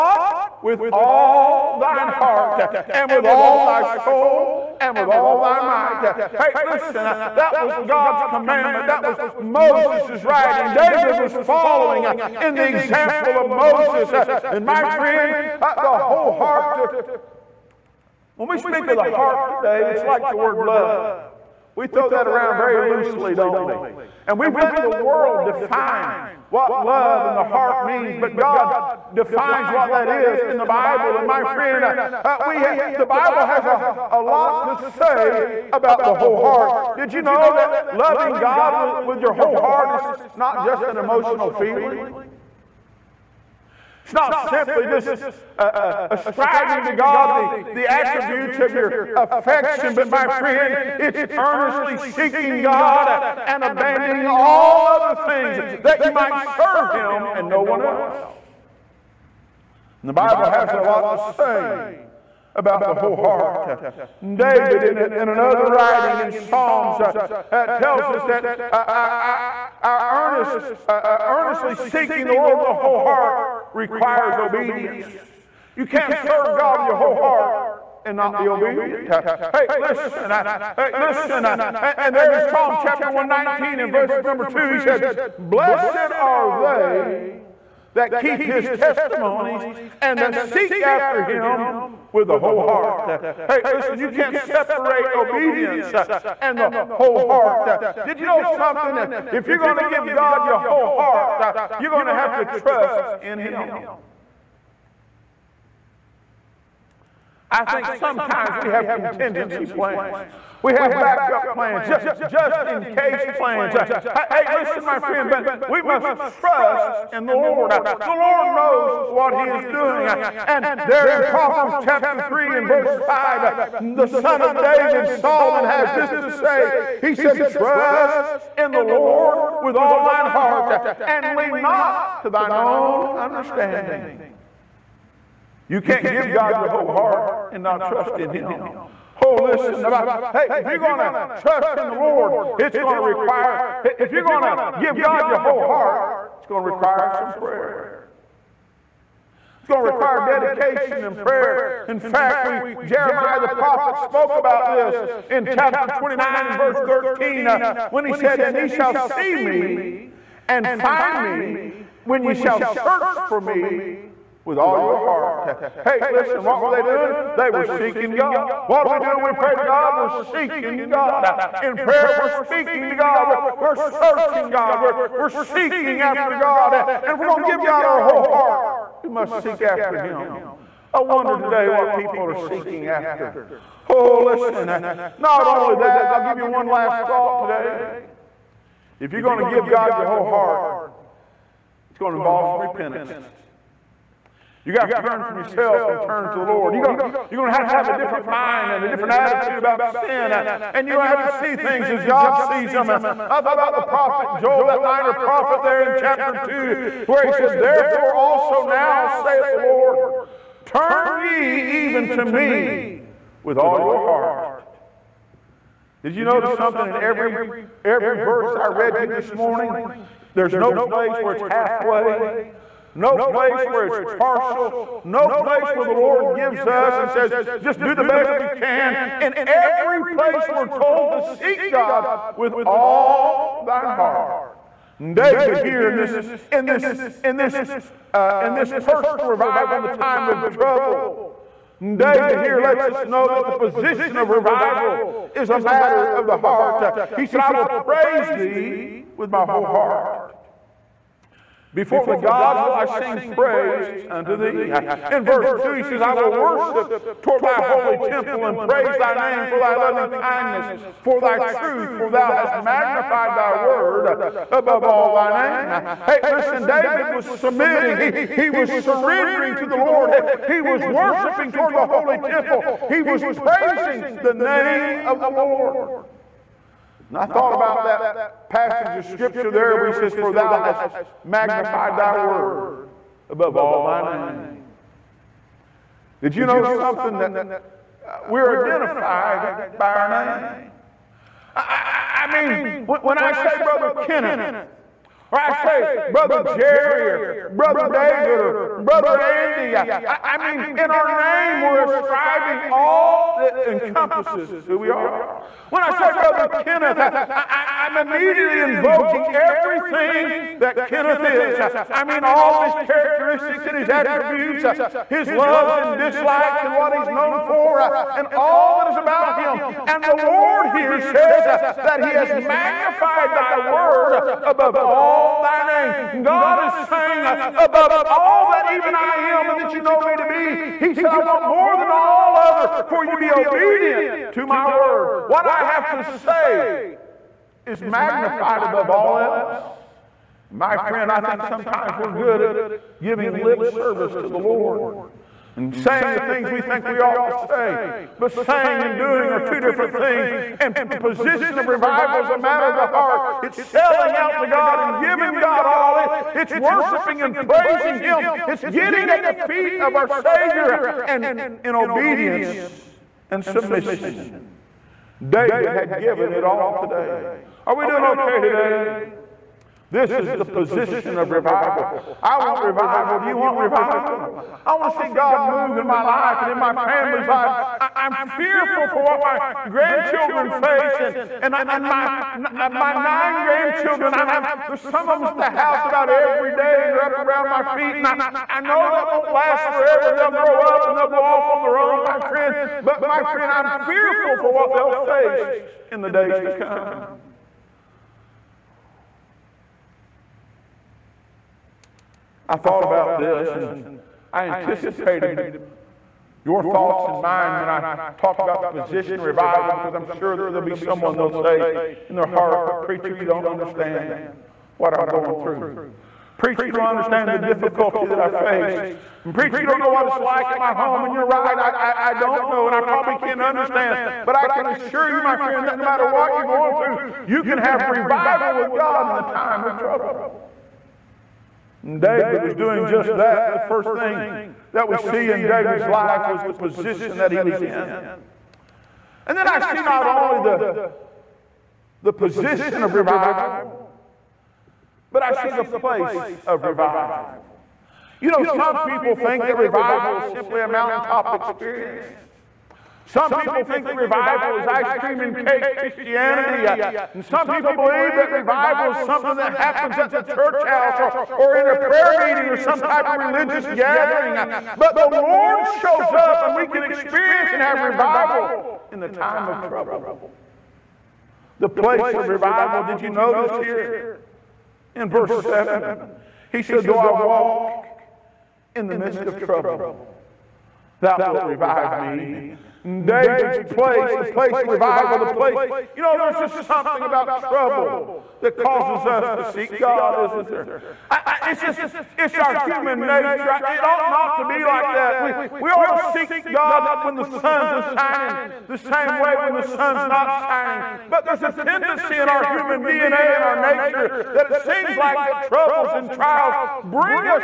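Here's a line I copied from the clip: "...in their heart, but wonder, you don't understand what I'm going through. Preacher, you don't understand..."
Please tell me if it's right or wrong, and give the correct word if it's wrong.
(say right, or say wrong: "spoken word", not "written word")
wrong: "preacher", not "wonder".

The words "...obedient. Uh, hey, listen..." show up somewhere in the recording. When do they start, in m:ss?
1:18.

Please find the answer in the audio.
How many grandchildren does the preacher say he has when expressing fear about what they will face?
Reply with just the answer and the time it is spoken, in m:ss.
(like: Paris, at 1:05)
9, at 6:22.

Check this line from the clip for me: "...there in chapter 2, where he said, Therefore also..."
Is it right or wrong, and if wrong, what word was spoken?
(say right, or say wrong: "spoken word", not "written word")
right.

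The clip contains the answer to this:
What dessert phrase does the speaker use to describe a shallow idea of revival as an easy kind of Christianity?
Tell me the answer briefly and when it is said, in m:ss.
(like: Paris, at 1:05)
ice cream and cake, at 7:34.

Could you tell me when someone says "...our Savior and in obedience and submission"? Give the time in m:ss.
5:59.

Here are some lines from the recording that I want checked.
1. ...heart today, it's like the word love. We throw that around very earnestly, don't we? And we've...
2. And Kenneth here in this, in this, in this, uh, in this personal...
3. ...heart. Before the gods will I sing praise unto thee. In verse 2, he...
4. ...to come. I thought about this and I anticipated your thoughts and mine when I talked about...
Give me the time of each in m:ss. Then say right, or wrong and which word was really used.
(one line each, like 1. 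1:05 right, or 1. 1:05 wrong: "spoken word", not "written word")
1. 0:19 wrong: "loosely", not "earnestly"
2. 3:54 wrong: "David", not "Kenneth"
3. 4:09 right
4. 6:36 right.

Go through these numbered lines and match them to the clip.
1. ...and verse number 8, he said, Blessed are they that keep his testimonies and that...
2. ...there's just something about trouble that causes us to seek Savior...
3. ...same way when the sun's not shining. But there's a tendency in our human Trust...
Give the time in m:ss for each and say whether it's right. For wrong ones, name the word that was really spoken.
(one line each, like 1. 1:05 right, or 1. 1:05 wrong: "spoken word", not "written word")
1. 1:23 wrong: "2", not "8"
2. 8:06 wrong: "God", not "Savior"
3. 8:18 wrong: "DNA", not "Trust".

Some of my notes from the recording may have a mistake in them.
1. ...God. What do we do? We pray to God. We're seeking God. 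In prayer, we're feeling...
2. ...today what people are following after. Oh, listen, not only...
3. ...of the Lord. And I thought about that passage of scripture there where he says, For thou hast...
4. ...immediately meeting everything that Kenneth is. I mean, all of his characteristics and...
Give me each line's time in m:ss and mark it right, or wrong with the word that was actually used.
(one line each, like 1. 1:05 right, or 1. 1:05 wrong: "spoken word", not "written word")
1. 2:48 wrong: "speaking", not "feeling"
2. 3:01 wrong: "seeking", not "following"
3. 4:34 right
4. 5:08 wrong: "invoking", not "meeting".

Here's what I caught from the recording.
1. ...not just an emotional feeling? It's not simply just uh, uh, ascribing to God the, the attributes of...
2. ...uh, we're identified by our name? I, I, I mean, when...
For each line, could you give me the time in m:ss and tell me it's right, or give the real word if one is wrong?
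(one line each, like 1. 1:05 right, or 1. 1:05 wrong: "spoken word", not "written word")
1. 0:40 right
2. 4:48 right.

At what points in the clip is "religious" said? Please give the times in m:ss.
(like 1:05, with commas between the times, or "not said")
7:43.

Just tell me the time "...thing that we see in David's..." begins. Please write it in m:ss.
7:13.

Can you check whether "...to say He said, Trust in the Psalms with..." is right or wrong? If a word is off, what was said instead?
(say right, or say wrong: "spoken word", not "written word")
wrong: "Lord", not "Psalms".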